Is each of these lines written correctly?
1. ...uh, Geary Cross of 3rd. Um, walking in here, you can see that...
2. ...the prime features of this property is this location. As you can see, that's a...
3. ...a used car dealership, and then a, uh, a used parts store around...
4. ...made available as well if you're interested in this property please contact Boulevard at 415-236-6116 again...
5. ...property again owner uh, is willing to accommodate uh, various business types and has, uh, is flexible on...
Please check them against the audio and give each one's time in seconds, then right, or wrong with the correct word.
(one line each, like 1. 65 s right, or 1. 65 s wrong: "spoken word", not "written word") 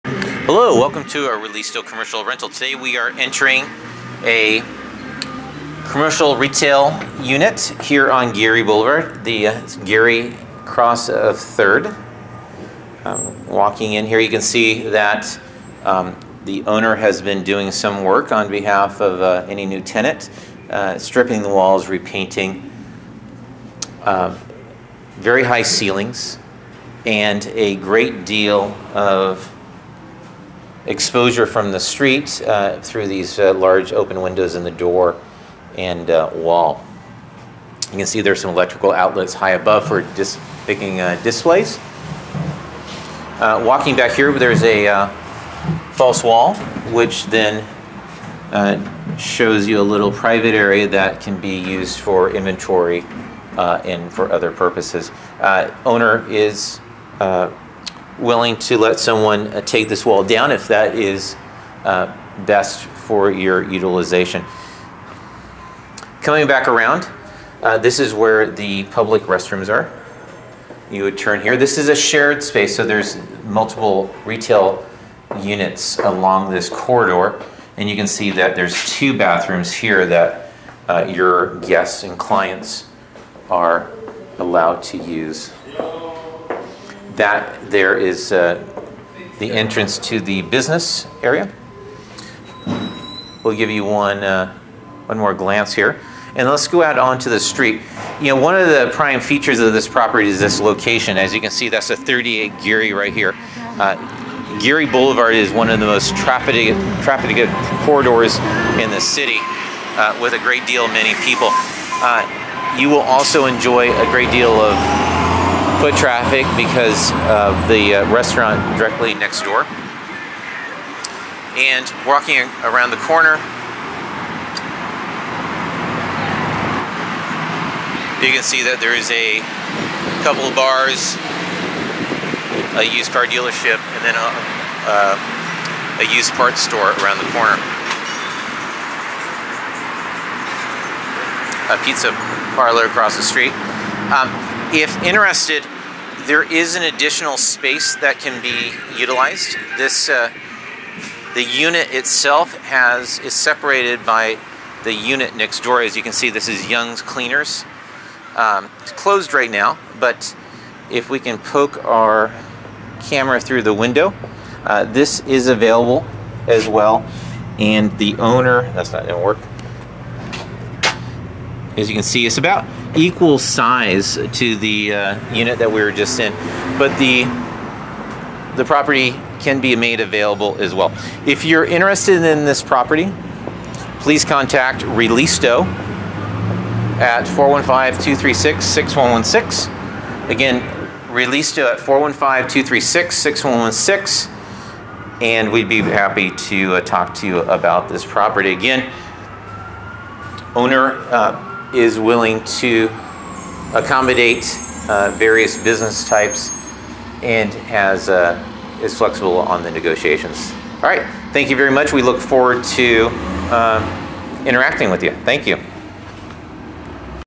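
1. 9 s right
2. 98 s right
3. 132 s right
4. 179 s wrong: "ReLISTO", not "Boulevard"
5. 198 s right.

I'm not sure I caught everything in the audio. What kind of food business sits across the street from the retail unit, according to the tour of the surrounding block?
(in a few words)
Pizza parlor.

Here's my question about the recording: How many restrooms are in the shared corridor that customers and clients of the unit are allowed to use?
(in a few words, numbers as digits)
2.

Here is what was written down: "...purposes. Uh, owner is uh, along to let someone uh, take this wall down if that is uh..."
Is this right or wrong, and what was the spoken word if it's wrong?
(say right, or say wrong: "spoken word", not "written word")
wrong: "willing", not "along".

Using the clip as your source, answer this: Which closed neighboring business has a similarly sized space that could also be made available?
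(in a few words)
Young's Cleaners.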